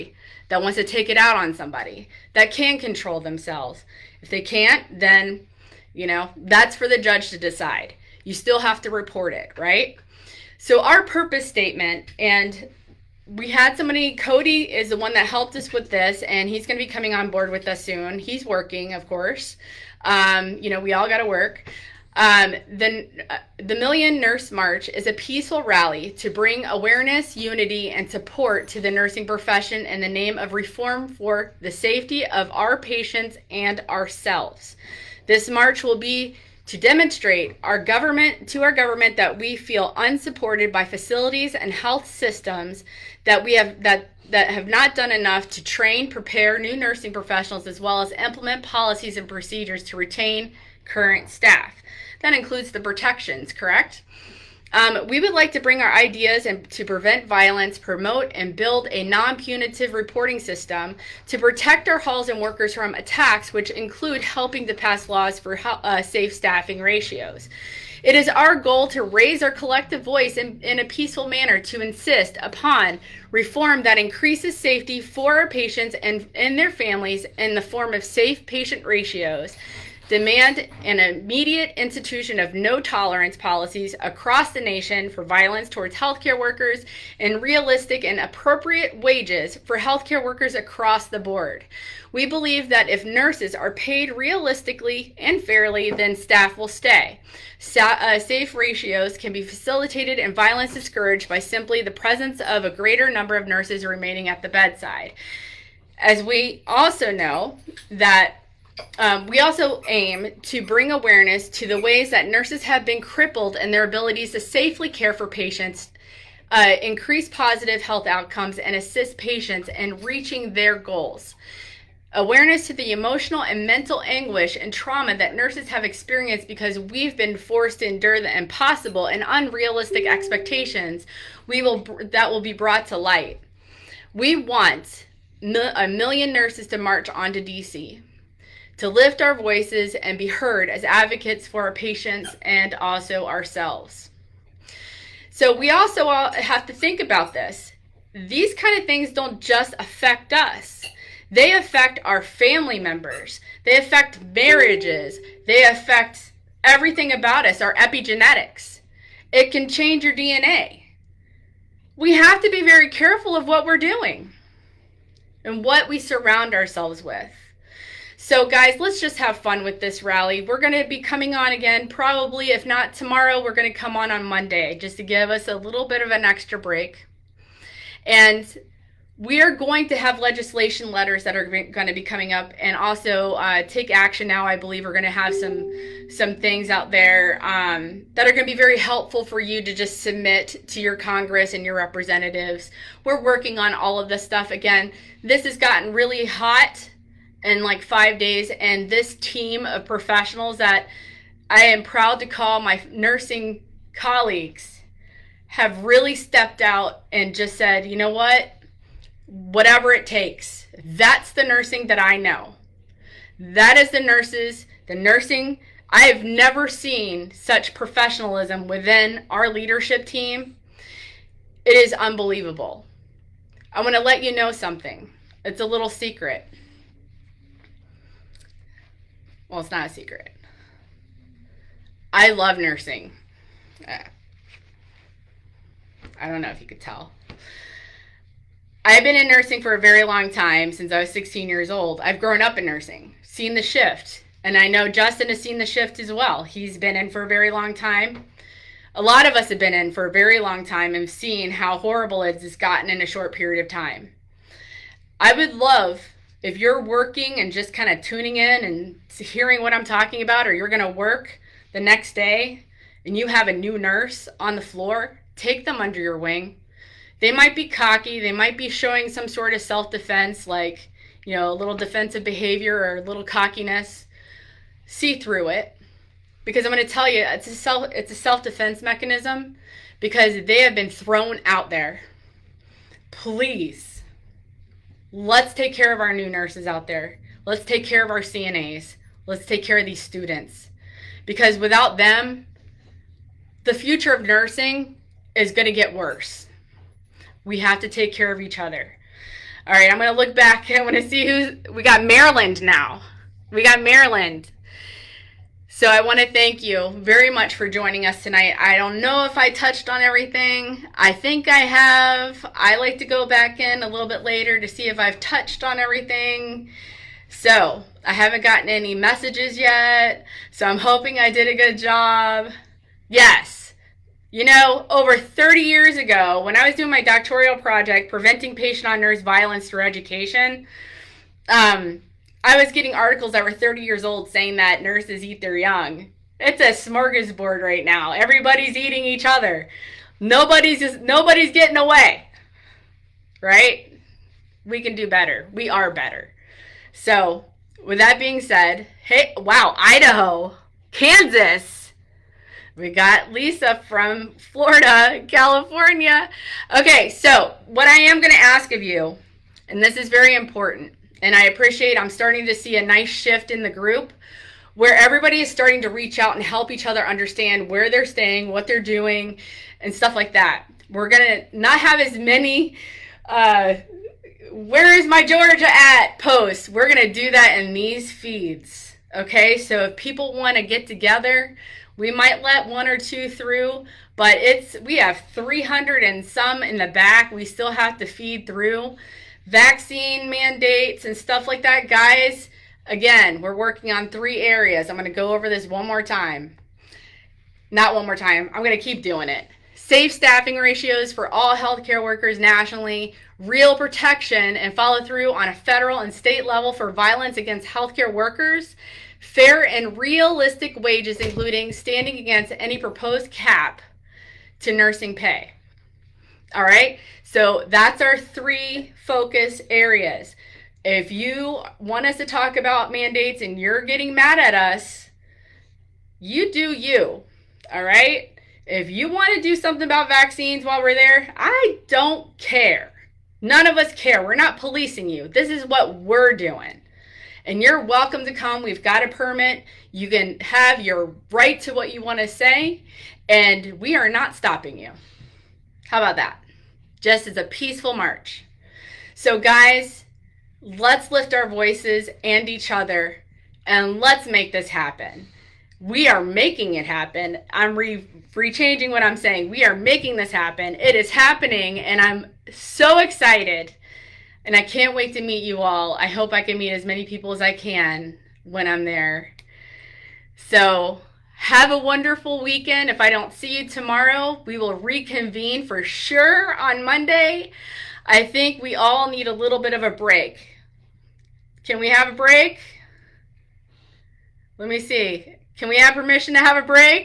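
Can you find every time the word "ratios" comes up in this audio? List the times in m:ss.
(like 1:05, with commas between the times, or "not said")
1:06, 1:18, 1:38, 6:40.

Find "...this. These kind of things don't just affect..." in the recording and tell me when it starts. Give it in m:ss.
2:27.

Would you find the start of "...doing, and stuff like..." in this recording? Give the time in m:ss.
6:08.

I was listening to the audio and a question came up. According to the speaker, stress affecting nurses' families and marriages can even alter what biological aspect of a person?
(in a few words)
epigenetics.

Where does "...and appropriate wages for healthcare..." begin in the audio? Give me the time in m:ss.
1:28.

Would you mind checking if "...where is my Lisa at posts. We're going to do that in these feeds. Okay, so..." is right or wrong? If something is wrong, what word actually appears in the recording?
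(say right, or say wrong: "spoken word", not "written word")
wrong: "Georgia", not "Lisa".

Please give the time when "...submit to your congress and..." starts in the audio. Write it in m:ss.
3:10.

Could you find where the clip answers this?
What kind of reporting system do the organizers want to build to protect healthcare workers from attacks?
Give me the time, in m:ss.
0:59.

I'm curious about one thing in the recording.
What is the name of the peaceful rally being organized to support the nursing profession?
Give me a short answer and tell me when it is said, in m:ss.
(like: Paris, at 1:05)
Million Nurse March, at 0:23.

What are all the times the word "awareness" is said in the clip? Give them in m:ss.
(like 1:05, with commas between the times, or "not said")
0:26, 1:50, 2:02.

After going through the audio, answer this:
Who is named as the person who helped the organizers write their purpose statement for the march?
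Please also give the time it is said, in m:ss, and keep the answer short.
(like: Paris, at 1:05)
Cody, at 0:14.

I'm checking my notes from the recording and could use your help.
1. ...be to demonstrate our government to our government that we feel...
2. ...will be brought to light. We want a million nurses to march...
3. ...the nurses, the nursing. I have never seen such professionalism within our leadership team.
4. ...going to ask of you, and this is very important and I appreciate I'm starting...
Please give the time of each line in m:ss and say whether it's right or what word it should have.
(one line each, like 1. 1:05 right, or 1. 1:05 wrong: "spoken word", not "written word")
1. 0:35 right
2. 2:12 right
3. 3:33 right
4. 5:58 right.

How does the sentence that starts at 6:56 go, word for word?
All right, so that's our three focus areas.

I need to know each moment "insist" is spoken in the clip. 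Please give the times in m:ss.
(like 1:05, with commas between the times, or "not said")
1:11.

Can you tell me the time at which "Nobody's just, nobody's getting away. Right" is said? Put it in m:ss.
5:40.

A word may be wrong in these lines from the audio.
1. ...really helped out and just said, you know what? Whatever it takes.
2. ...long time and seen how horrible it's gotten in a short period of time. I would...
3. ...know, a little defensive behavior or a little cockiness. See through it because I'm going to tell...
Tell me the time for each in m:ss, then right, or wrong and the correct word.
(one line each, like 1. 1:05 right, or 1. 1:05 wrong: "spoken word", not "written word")
1. 3:25 wrong: "stepped", not "helped"
2. 4:10 right
3. 4:31 right.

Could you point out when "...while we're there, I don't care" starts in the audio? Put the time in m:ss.
7:10.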